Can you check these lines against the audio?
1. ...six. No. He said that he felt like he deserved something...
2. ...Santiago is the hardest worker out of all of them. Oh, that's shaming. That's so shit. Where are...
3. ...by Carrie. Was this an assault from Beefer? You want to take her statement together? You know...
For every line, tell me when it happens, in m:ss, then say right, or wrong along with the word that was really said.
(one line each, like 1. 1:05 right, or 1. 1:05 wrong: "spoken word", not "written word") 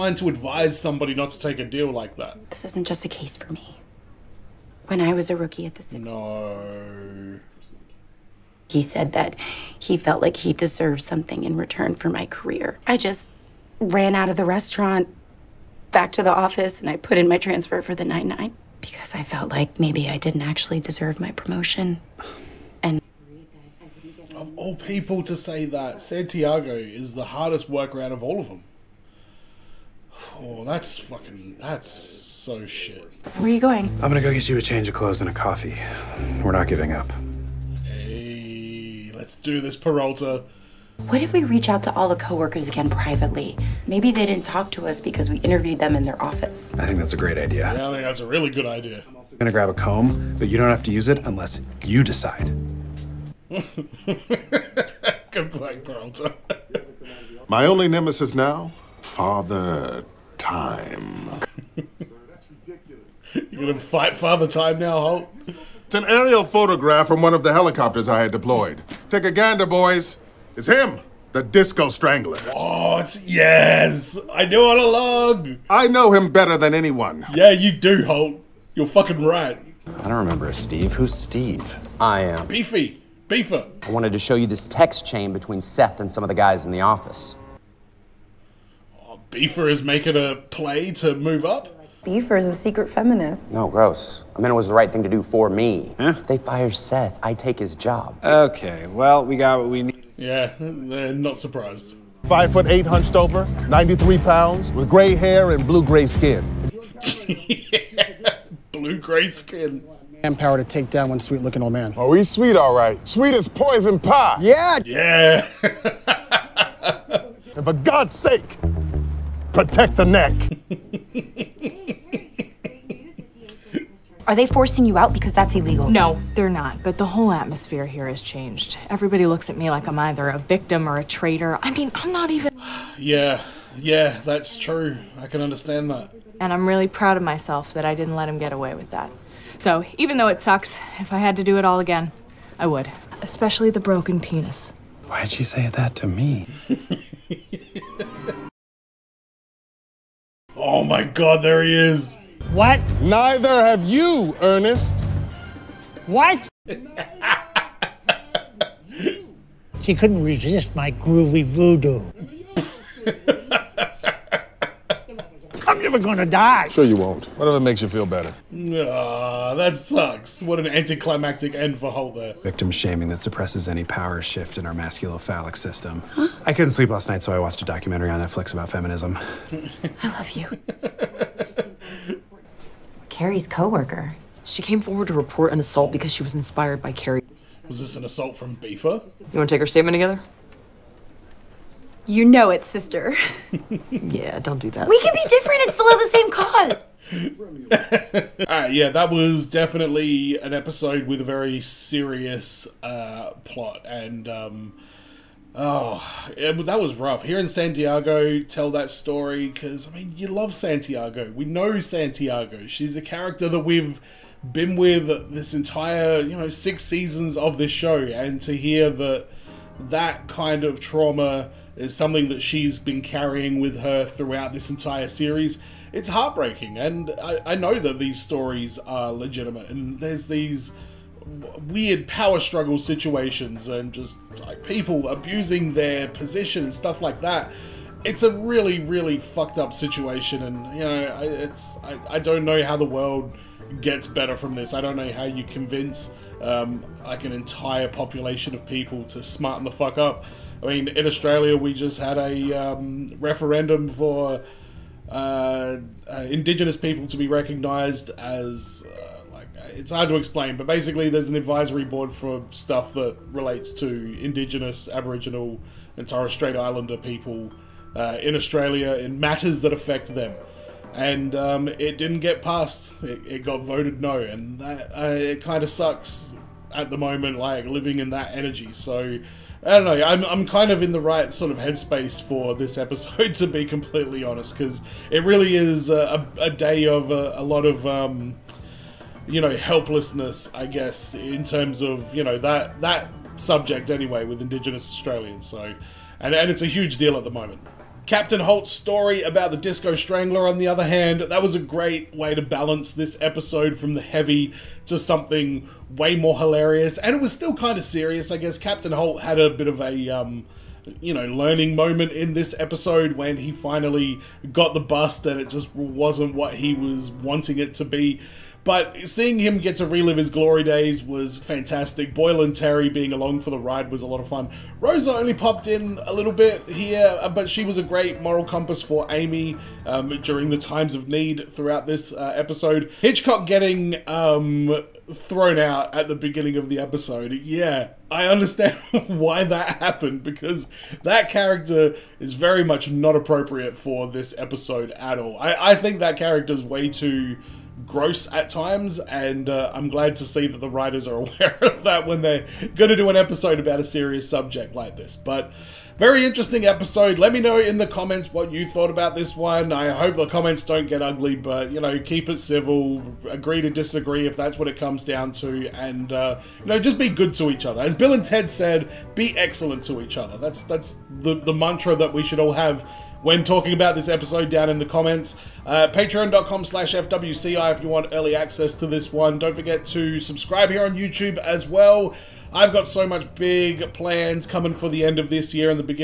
1. 0:05 right
2. 0:26 wrong: "fucking", not "shaming"
3. 3:06 right.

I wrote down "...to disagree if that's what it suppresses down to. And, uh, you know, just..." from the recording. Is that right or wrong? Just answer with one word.
wrong.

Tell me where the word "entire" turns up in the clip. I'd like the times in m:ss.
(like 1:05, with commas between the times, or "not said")
3:35, 3:44, 4:07.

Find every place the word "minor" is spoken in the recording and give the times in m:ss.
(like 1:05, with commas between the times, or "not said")
not said.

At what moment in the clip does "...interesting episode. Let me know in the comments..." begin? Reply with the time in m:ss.
5:56.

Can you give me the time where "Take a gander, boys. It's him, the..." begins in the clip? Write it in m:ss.
1:09.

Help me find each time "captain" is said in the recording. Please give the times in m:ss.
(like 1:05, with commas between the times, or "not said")
4:58, 5:08.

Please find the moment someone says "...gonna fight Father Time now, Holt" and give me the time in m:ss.
1:03.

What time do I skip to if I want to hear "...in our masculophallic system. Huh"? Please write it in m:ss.
2:54.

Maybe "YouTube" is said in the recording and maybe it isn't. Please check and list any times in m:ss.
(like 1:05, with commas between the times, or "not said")
6:20.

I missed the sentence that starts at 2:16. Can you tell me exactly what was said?
And I'm really proud of myself that I didn't let him get away with that.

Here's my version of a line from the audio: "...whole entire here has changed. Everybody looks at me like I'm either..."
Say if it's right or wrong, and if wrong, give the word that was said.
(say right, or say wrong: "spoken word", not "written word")
wrong: "atmosphere", not "entire".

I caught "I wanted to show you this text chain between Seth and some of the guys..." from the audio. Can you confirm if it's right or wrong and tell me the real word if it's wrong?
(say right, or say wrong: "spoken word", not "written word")
right.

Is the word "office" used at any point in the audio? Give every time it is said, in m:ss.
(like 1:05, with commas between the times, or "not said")
0:16, 0:46, 1:26.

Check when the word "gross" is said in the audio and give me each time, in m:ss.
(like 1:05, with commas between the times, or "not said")
1:33, 5:47.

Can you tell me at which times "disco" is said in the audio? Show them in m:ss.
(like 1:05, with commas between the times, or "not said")
1:11, 4:59.